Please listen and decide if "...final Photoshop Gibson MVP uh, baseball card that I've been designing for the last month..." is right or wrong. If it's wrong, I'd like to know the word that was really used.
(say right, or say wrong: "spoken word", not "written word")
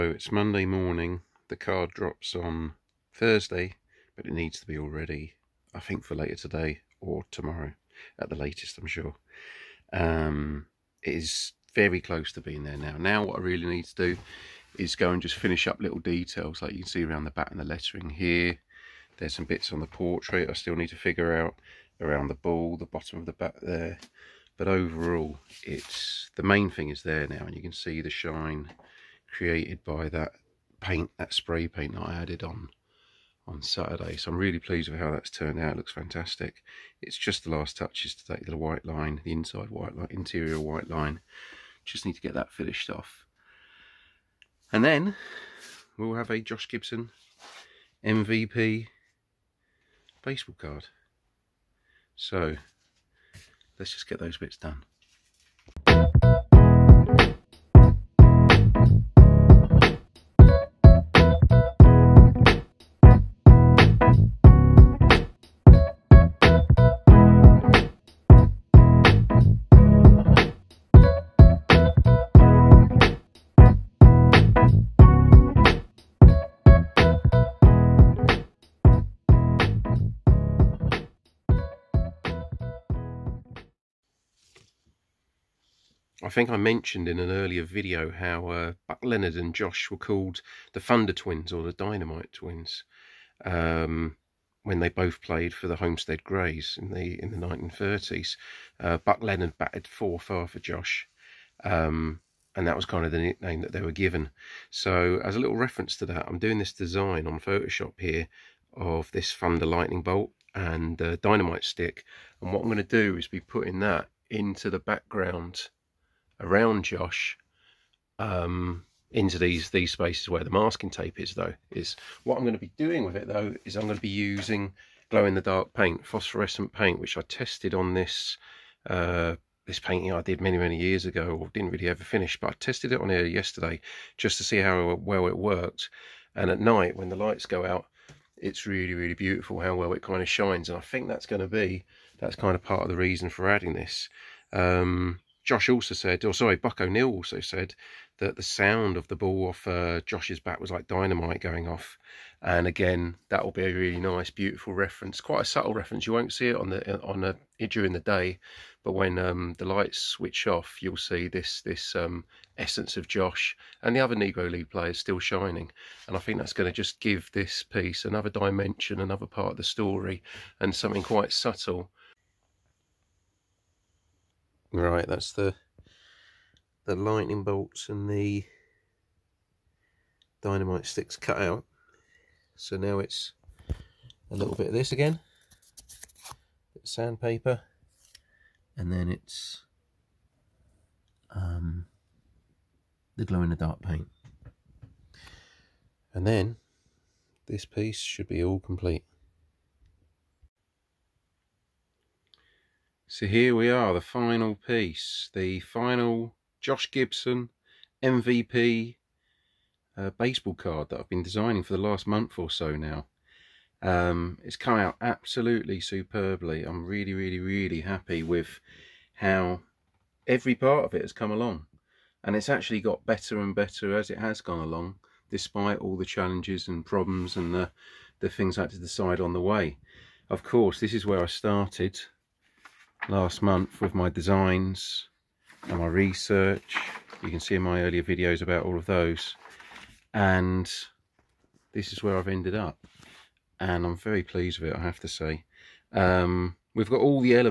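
wrong: "Josh", not "Photoshop".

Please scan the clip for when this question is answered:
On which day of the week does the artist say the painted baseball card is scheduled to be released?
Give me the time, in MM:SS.
00:03.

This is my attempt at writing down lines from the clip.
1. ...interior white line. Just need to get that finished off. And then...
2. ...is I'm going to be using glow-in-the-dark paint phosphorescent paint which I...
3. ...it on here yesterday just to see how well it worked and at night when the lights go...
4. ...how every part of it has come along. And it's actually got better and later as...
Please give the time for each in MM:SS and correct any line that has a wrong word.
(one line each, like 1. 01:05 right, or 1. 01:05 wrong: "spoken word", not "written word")
1. 00:40 right
2. 02:03 right
3. 02:12 right
4. 03:39 wrong: "better", not "later".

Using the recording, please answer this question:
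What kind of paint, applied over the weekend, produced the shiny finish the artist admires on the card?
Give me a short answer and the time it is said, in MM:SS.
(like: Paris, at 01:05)
Spray paint, at 00:31.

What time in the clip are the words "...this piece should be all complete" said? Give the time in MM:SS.
03:17.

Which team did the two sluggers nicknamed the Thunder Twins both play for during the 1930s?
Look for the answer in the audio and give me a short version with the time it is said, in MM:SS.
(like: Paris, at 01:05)
Homestead Grays, at 01:35.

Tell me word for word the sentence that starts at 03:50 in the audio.
Of course, this is where I started last month with my designs and my research.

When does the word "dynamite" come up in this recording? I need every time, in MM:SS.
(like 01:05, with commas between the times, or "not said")
01:31, 01:51, 02:30, 03:00.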